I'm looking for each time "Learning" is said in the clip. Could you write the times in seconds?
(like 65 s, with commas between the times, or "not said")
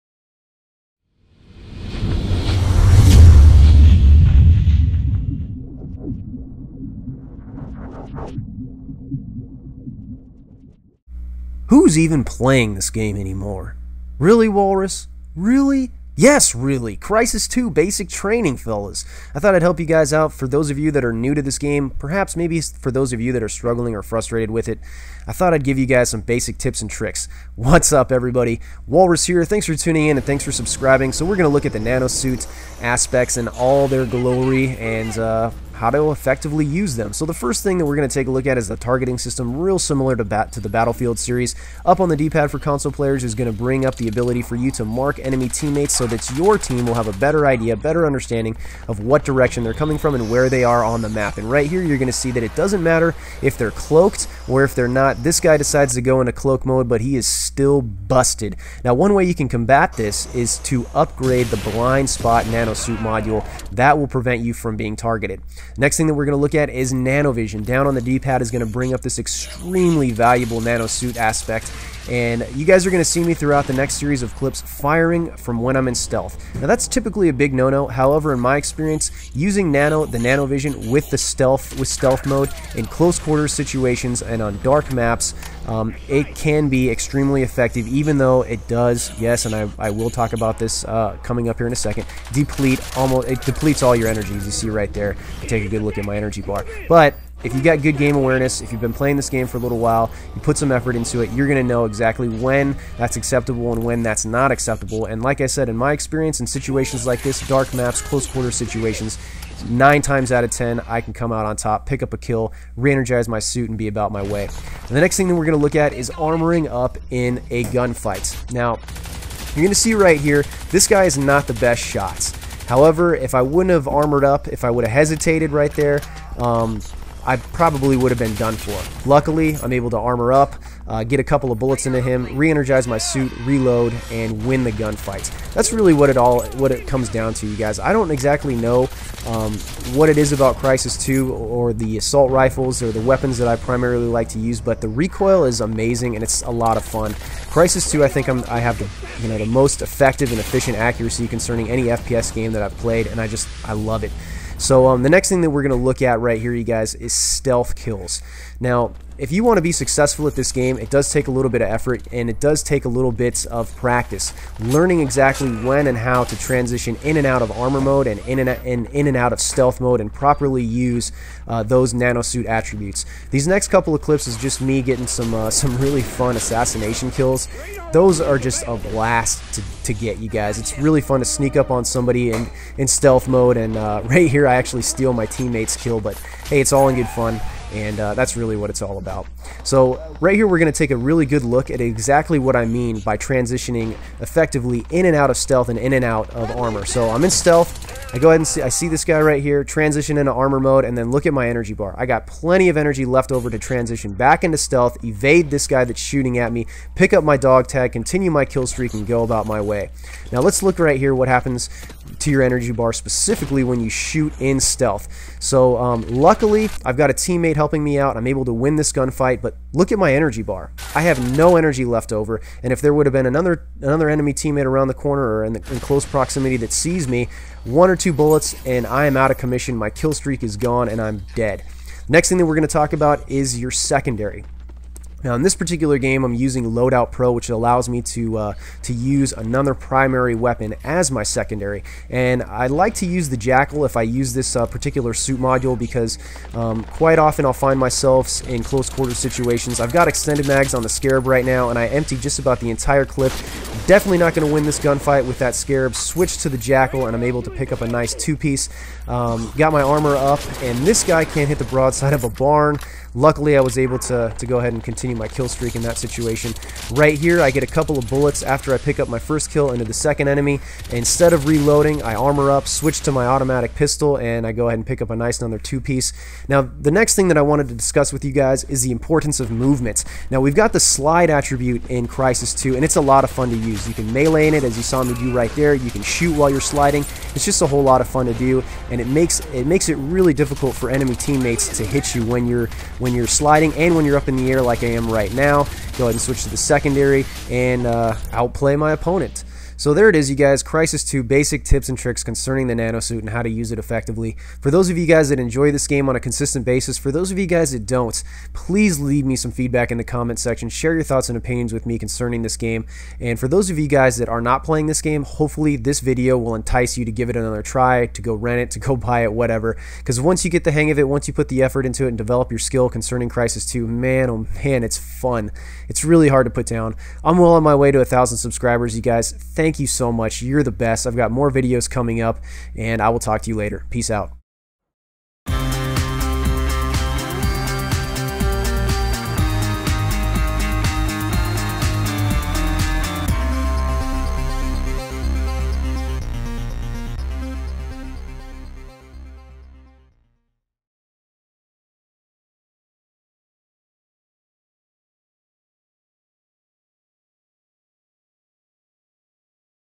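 164 s.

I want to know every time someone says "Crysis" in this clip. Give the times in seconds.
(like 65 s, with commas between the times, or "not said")
16 s, 140 s, 147 s, 282 s, 300 s, 323 s.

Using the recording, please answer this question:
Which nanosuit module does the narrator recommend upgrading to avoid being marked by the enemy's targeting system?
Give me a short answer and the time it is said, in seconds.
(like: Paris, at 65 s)
Blind spot, at 61 s.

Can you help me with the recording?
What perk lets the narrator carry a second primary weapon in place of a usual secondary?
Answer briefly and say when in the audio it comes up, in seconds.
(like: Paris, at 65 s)
Loadout Pro, at 236 s.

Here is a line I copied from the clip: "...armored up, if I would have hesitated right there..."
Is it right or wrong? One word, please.
right.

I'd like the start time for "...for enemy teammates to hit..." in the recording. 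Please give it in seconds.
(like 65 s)
290 s.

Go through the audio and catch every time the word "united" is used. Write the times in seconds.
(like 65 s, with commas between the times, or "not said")
not said.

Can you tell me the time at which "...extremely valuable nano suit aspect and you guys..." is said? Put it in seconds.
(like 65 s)
69 s.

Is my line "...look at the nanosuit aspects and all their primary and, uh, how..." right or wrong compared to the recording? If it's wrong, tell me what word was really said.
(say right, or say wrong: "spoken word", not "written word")
wrong: "glory", not "primary".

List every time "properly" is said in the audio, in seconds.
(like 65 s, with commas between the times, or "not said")
170 s.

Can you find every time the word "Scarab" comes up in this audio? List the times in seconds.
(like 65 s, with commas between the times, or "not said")
250 s, 255 s.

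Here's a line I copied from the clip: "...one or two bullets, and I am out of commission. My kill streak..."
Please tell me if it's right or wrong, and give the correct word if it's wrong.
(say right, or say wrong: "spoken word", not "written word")
right.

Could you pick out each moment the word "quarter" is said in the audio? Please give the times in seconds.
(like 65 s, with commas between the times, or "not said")
83 s, 108 s, 248 s.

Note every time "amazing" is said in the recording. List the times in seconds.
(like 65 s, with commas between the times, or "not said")
145 s.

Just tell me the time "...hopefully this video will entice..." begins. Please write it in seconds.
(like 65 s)
315 s.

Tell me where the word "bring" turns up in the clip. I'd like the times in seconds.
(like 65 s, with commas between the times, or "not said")
43 s, 68 s.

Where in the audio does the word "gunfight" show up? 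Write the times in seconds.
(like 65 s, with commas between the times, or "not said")
117 s, 134 s, 218 s, 254 s.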